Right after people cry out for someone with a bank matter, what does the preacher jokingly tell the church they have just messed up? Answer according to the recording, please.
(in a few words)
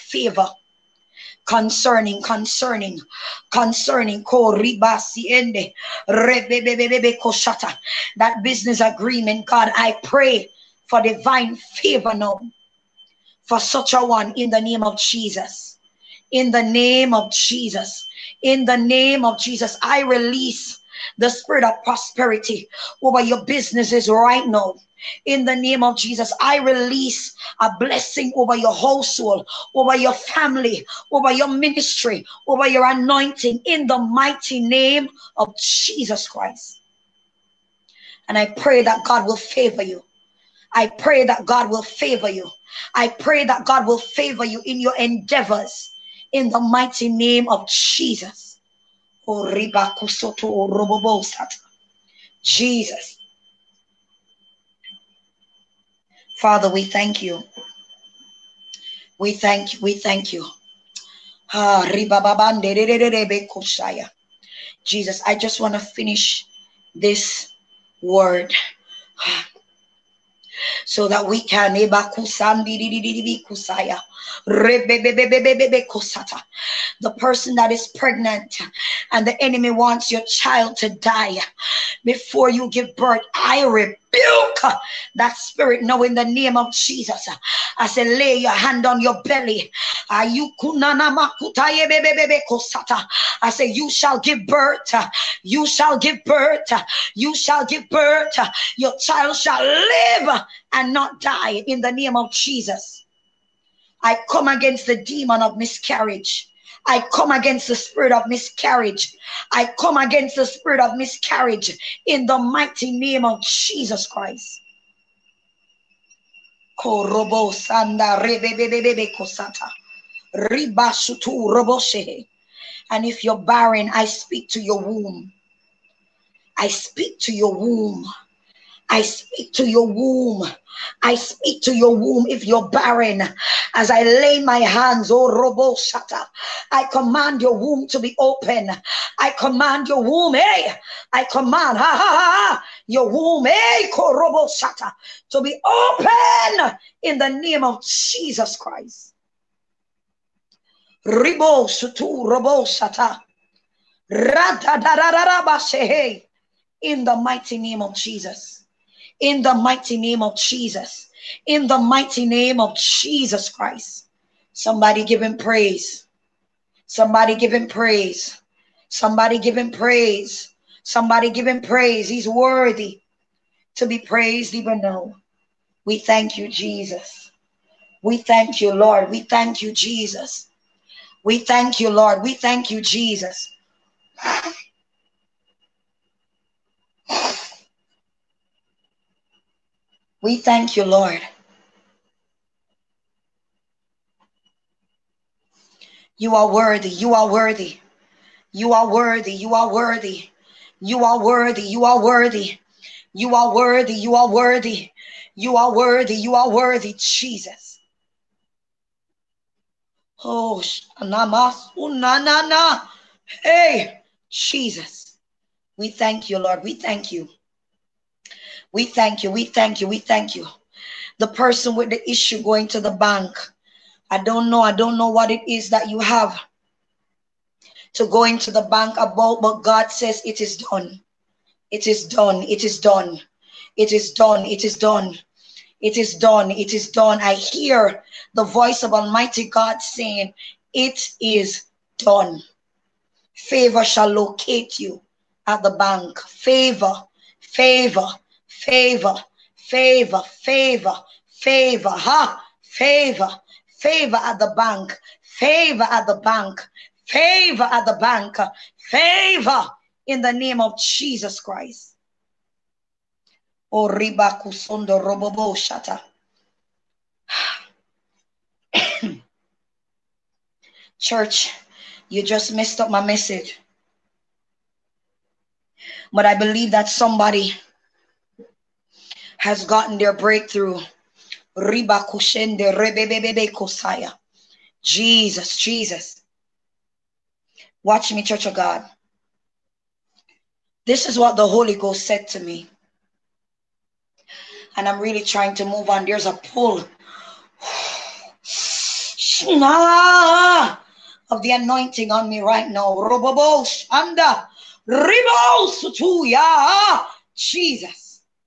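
my message.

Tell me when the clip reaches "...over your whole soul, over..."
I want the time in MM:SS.
00:28.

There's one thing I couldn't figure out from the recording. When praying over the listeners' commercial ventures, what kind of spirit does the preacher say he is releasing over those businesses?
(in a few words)
prosperity.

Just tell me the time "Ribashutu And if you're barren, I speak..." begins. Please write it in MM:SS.
02:00.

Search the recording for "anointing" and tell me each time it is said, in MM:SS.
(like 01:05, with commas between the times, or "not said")
00:32, 05:01.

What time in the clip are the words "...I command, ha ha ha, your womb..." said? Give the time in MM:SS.
02:21.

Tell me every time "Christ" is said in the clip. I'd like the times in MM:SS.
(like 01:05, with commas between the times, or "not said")
00:36, 01:54, 02:28, 02:43, 04:21.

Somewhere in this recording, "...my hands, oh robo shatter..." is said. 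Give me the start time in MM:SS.
02:14.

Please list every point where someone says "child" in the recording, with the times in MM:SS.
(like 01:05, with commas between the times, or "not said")
01:20, 01:38.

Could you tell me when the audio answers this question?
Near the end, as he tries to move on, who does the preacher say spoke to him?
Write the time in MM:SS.
04:51.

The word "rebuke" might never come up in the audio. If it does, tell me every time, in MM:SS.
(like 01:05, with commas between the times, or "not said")
01:24.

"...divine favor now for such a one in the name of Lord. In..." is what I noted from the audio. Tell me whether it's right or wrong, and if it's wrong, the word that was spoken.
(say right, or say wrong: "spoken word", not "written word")
wrong: "Jesus", not "Lord".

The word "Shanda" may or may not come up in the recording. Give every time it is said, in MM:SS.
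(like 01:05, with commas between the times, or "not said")
05:03.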